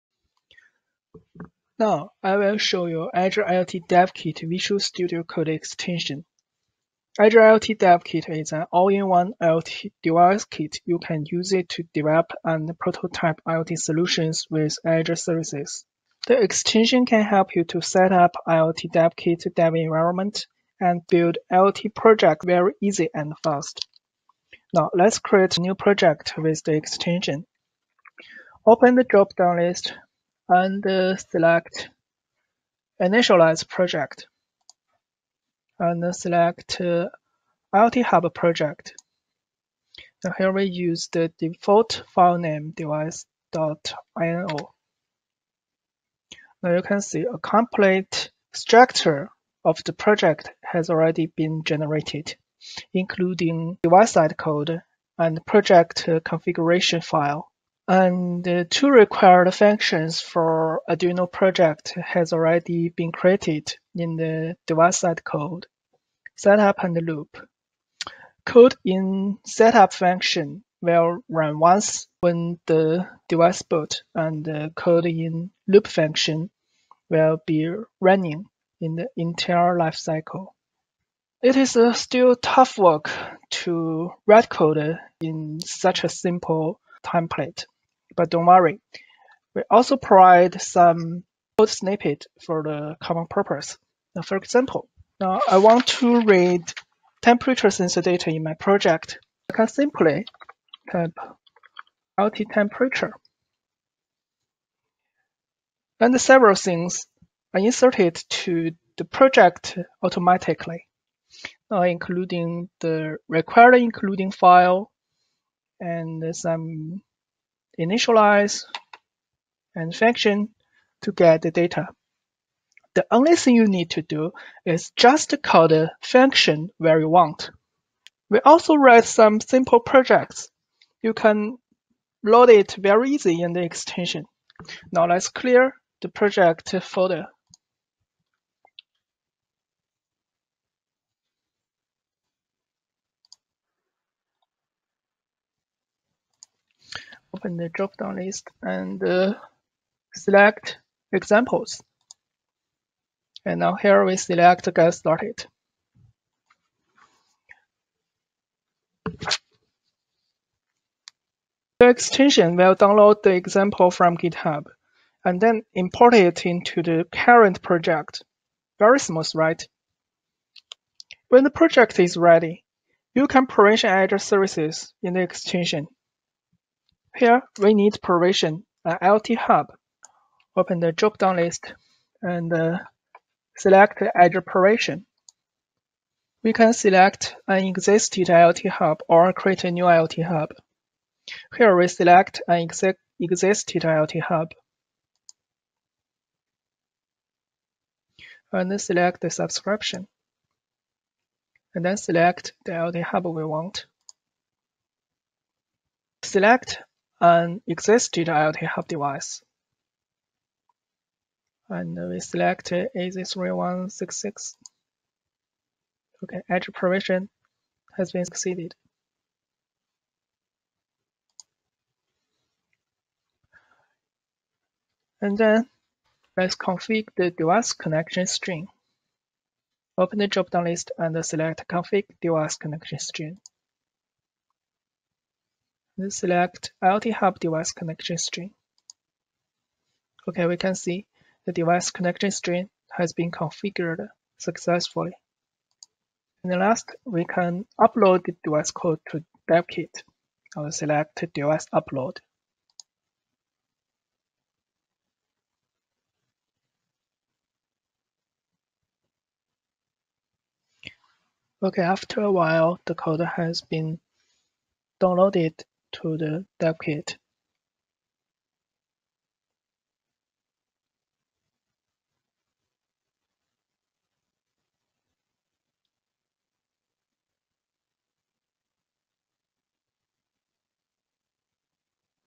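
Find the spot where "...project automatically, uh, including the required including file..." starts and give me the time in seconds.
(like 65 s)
109 s.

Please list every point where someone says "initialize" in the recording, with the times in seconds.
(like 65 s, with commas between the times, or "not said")
33 s, 117 s.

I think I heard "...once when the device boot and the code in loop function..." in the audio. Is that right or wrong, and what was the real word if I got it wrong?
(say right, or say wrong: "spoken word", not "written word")
right.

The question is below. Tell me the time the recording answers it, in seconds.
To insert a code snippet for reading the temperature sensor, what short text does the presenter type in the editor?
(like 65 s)
102 s.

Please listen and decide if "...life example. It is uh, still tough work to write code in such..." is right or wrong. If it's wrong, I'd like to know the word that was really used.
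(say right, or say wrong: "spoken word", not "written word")
wrong: "cycle", not "example".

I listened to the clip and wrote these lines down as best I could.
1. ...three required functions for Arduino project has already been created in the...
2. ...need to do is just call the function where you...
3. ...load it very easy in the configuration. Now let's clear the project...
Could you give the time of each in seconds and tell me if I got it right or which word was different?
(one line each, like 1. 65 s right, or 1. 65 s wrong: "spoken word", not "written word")
1. 58 s wrong: "two", not "three"
2. 123 s right
3. 132 s wrong: "extension", not "configuration".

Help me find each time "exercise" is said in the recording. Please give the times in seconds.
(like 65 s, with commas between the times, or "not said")
not said.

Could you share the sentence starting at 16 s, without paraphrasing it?
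The extension can help you to set up IoT DevKit dev environment and build IoT project very easy and fast.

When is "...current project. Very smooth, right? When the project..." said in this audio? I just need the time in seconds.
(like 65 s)
167 s.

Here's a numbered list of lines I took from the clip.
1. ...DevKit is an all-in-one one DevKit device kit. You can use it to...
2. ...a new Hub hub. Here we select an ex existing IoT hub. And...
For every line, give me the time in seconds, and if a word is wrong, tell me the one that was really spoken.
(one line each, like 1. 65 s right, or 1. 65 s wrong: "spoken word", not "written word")
1. 7 s wrong: "IoT", not "DevKit"
2. 189 s wrong: "IoT", not "Hub".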